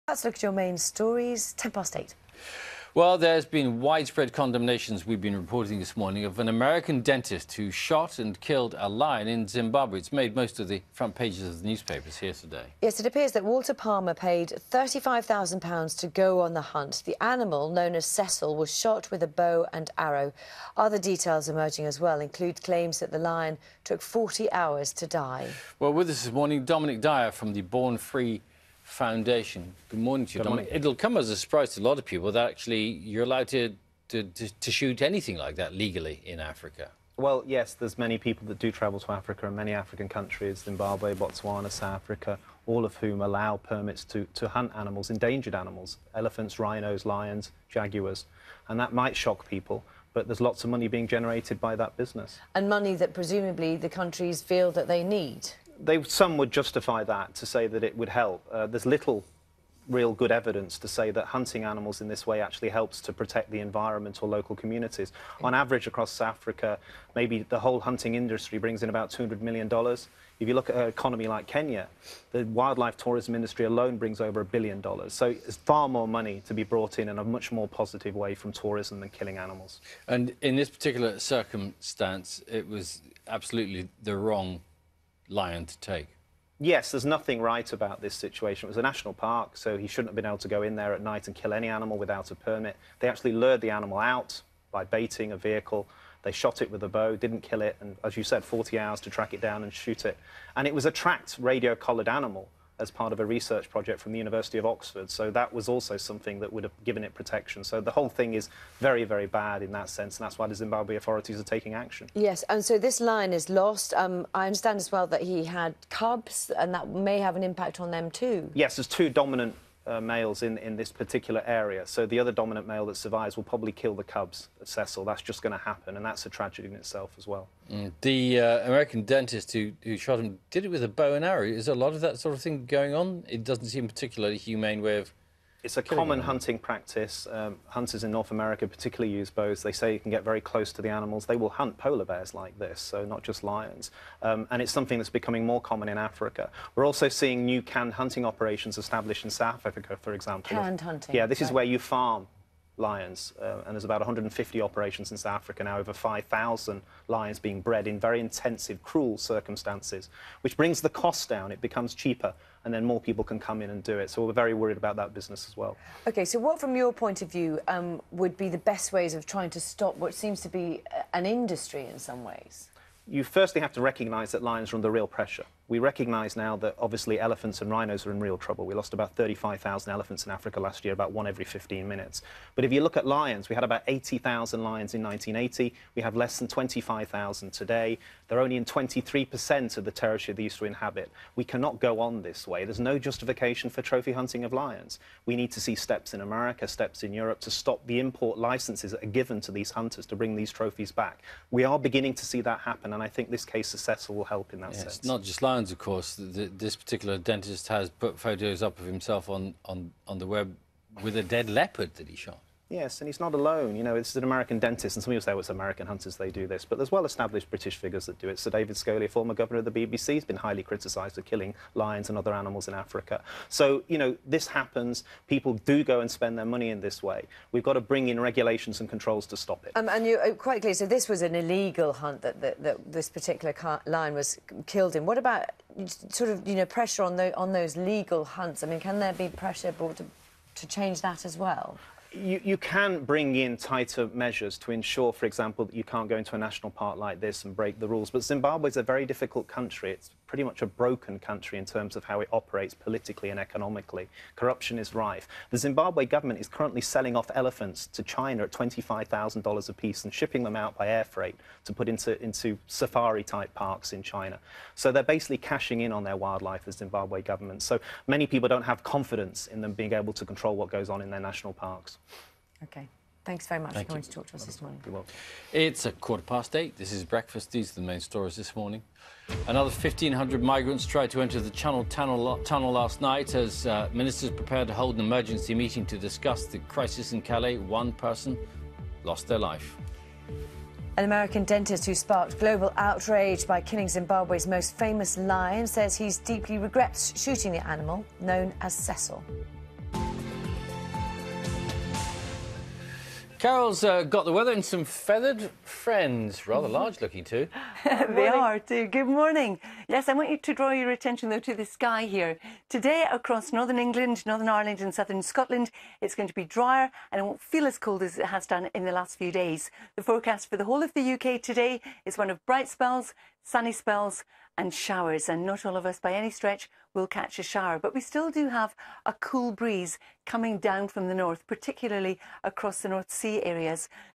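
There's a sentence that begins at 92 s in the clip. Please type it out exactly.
They actually lured the animal out by baiting a vehicle.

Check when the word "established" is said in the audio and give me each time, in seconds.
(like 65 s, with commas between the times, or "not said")
148 s, 216 s.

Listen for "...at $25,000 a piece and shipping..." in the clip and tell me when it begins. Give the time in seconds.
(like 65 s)
258 s.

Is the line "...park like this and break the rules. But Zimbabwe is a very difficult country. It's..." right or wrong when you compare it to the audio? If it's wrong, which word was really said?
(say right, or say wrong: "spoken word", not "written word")
right.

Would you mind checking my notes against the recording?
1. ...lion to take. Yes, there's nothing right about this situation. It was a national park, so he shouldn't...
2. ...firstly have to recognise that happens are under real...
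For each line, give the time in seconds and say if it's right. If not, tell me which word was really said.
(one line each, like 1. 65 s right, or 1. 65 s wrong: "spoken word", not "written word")
1. 85 s right
2. 173 s wrong: "lions", not "happens".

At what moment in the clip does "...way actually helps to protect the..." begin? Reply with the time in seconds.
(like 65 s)
62 s.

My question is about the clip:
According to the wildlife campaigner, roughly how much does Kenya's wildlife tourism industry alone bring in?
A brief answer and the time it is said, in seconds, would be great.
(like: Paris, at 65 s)
over a billion dollars, at 74 s.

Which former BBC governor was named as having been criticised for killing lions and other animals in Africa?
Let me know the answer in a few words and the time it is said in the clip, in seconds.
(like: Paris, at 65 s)
Sir David Scholey, at 218 s.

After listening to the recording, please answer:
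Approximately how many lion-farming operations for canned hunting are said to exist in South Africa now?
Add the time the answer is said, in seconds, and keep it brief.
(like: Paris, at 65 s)
150, at 154 s.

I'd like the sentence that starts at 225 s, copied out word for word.
People do go and spend their money in this way.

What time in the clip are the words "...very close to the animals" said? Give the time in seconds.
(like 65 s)
140 s.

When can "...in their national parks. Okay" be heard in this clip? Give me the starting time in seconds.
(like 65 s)
271 s.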